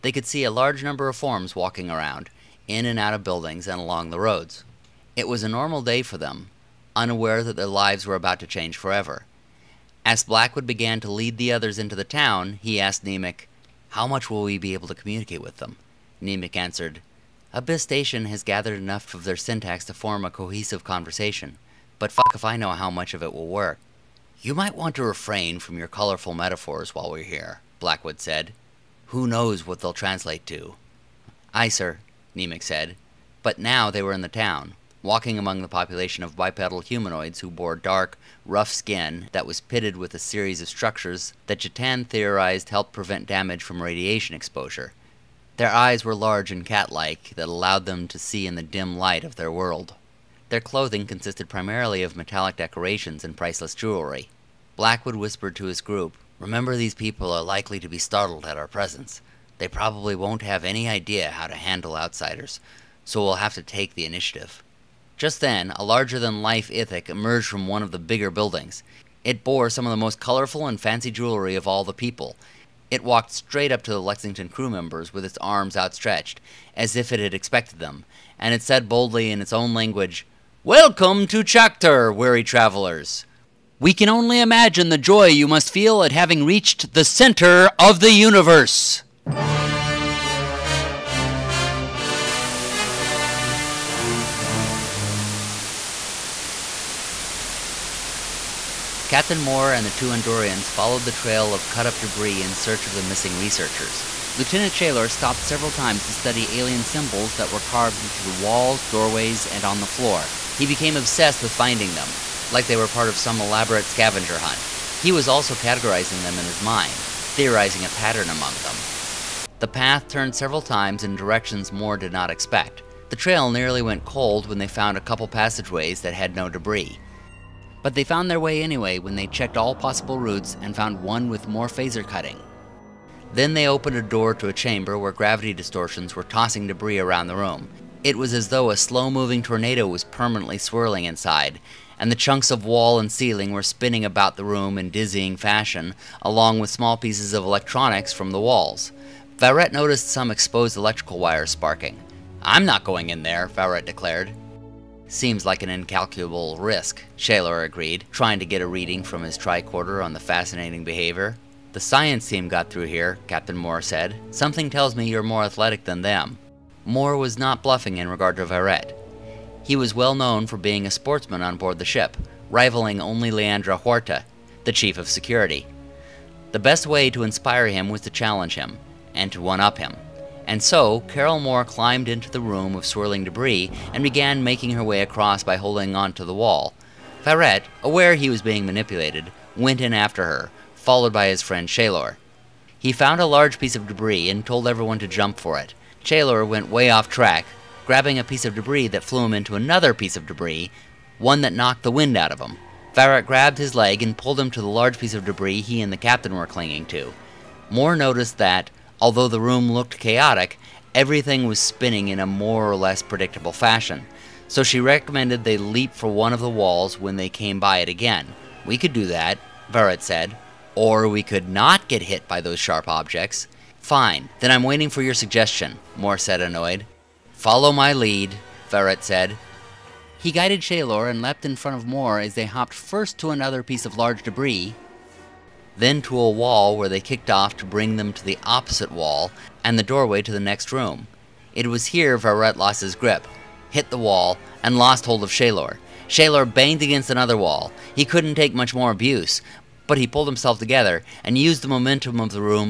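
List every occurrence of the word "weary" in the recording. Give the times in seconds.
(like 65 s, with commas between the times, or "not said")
82 s.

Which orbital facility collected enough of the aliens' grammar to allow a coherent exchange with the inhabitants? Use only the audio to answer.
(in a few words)
Abyss Station.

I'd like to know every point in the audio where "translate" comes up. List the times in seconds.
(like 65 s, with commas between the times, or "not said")
29 s.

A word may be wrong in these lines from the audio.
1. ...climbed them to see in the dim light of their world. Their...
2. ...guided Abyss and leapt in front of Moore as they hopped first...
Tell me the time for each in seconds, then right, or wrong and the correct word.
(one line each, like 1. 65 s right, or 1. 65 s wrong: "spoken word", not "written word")
1. 47 s wrong: "allowed", not "climbed"
2. 230 s wrong: "Shalor", not "Abyss".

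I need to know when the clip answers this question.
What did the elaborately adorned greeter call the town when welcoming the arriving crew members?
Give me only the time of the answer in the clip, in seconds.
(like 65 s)
81 s.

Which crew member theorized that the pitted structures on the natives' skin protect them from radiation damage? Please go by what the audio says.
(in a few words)
Jatan.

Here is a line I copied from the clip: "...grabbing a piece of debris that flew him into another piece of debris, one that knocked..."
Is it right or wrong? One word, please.
right.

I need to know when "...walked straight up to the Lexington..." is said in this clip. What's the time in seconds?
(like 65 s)
73 s.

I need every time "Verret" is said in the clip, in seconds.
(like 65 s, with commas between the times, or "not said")
202 s.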